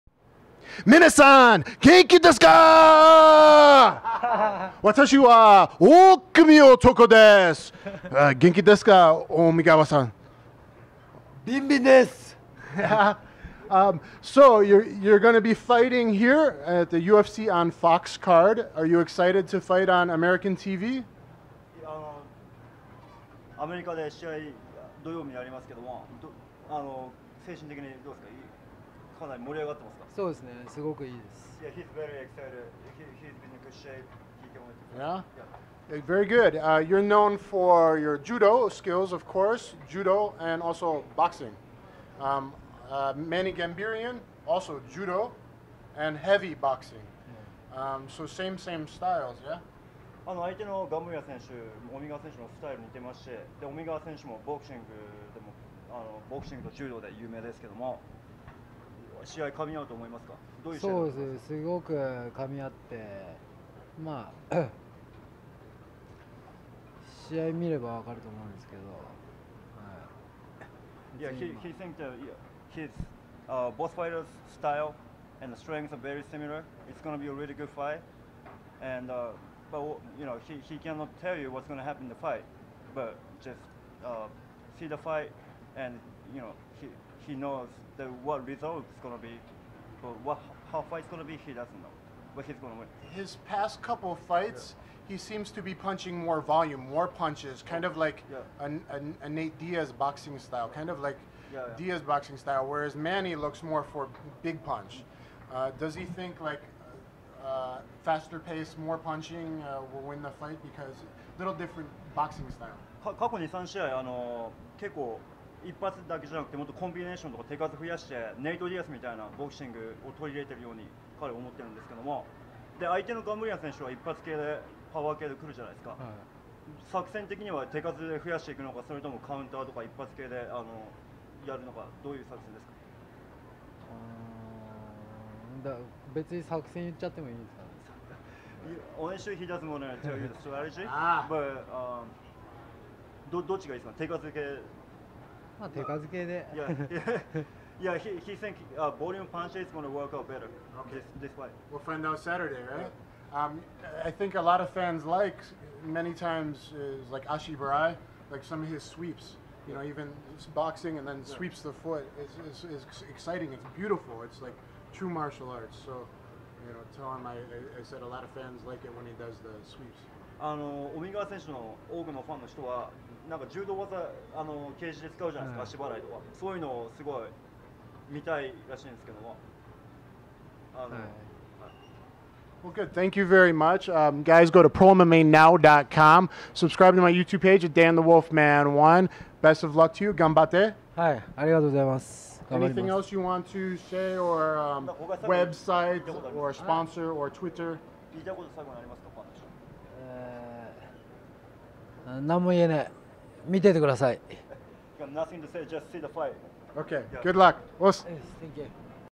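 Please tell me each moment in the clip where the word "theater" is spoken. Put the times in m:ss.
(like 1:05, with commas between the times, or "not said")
not said.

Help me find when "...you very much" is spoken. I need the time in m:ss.
3:03.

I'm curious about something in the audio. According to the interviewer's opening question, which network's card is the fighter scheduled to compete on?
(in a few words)
Fox.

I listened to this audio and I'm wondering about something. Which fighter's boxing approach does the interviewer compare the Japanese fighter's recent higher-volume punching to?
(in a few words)
Nate Diaz.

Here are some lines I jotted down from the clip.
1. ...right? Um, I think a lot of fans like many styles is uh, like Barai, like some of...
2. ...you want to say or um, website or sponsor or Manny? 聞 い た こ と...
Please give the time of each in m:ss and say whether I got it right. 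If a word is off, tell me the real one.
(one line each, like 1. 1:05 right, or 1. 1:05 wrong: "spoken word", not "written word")
1. 2:32 wrong: "times", not "styles"
2. 3:13 wrong: "Twitter", not "Manny".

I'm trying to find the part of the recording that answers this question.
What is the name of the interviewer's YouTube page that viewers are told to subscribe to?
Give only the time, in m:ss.
3:07.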